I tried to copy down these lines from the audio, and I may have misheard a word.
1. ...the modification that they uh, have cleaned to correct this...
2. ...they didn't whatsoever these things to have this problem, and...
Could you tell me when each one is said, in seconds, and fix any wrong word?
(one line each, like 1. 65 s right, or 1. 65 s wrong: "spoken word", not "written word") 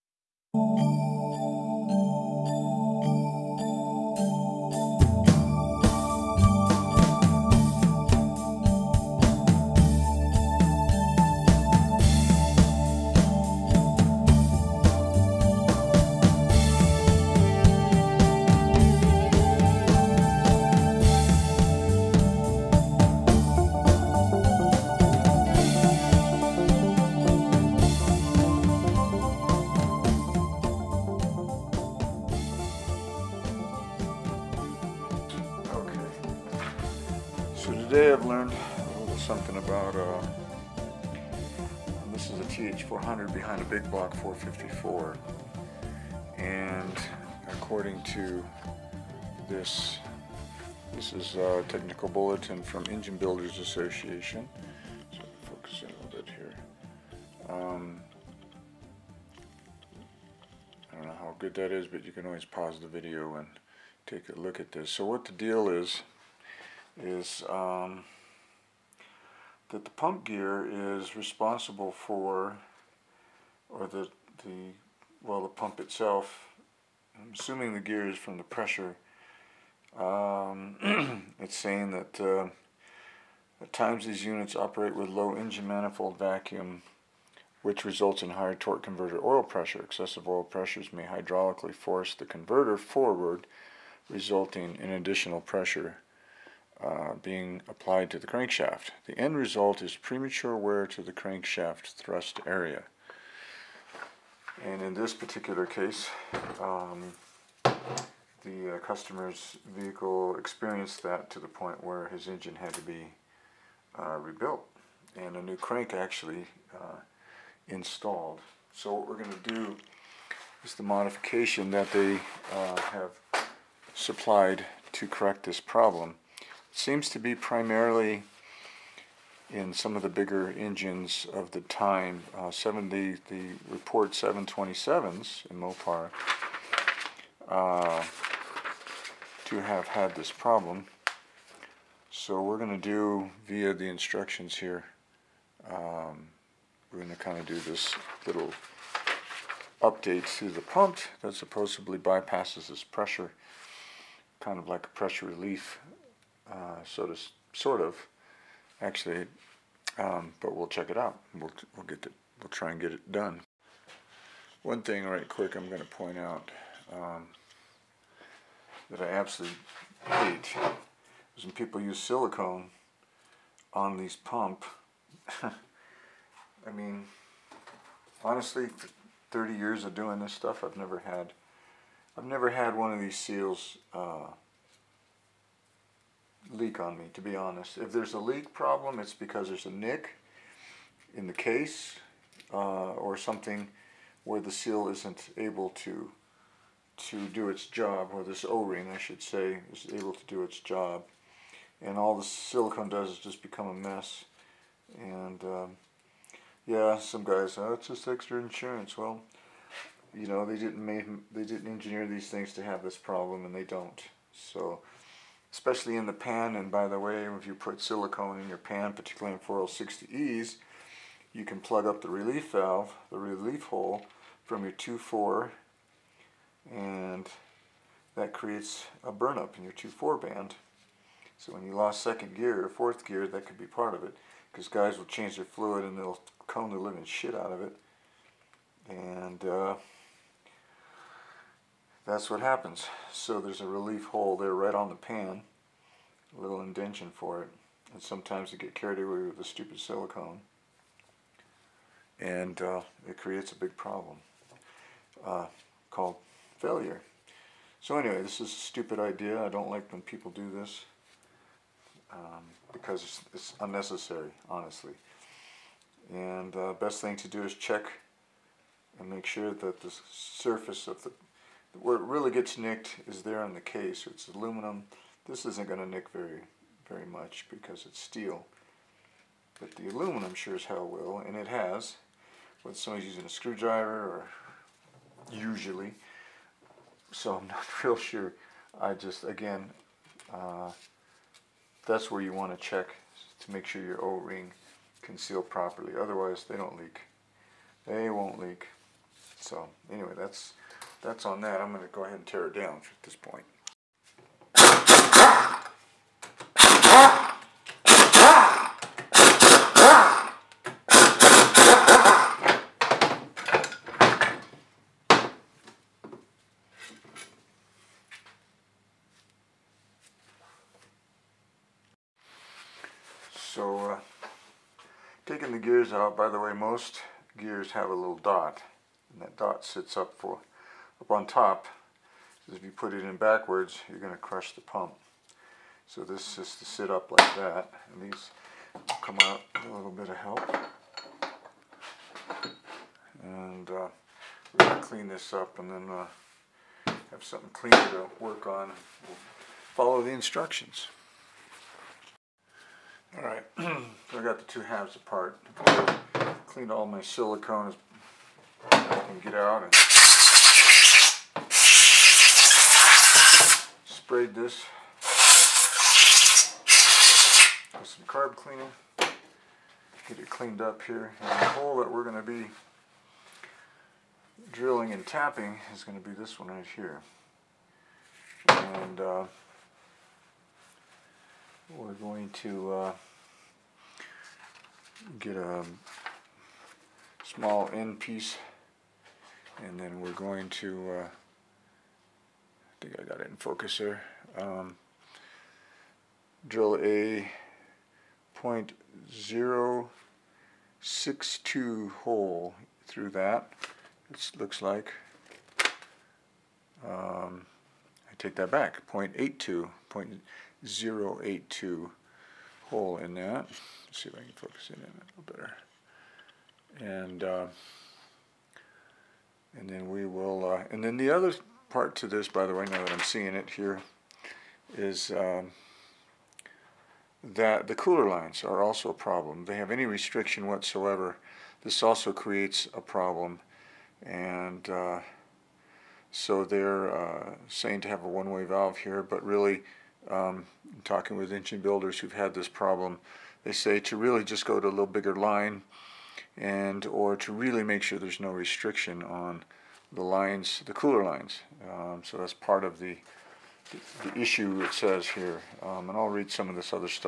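1. 120 s wrong: "supplied", not "cleaned"
2. 211 s wrong: "engineer", not "whatsoever".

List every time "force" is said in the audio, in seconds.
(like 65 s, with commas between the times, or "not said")
91 s.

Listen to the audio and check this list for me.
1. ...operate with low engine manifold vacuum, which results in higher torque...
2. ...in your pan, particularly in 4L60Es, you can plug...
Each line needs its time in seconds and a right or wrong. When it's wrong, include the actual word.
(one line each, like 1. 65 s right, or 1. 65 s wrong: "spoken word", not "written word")
1. 84 s right
2. 218 s right.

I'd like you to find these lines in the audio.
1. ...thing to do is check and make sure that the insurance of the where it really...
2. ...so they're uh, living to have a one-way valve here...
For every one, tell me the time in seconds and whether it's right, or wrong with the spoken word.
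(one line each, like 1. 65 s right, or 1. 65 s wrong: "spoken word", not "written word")
1. 267 s wrong: "surface", not "insurance"
2. 436 s wrong: "saying", not "living".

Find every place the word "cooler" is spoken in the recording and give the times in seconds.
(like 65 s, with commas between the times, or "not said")
427 s, 450 s.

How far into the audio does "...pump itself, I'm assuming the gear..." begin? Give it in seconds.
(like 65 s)
75 s.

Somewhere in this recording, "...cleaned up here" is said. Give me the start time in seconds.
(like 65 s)
370 s.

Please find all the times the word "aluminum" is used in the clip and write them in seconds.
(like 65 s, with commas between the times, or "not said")
274 s, 279 s.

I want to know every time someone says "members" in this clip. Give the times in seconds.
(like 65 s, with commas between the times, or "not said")
not said.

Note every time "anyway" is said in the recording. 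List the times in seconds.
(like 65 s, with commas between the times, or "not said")
257 s, 299 s.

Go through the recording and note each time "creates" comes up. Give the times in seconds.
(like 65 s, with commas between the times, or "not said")
228 s, 253 s, 432 s.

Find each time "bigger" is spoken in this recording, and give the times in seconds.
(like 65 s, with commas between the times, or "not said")
130 s, 444 s.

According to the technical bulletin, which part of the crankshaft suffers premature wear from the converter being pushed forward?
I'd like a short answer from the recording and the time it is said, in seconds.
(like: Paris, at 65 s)
thrust area, at 101 s.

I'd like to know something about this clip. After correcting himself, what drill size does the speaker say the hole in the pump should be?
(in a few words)
0.082.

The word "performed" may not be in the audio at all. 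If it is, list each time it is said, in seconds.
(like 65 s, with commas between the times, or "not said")
not said.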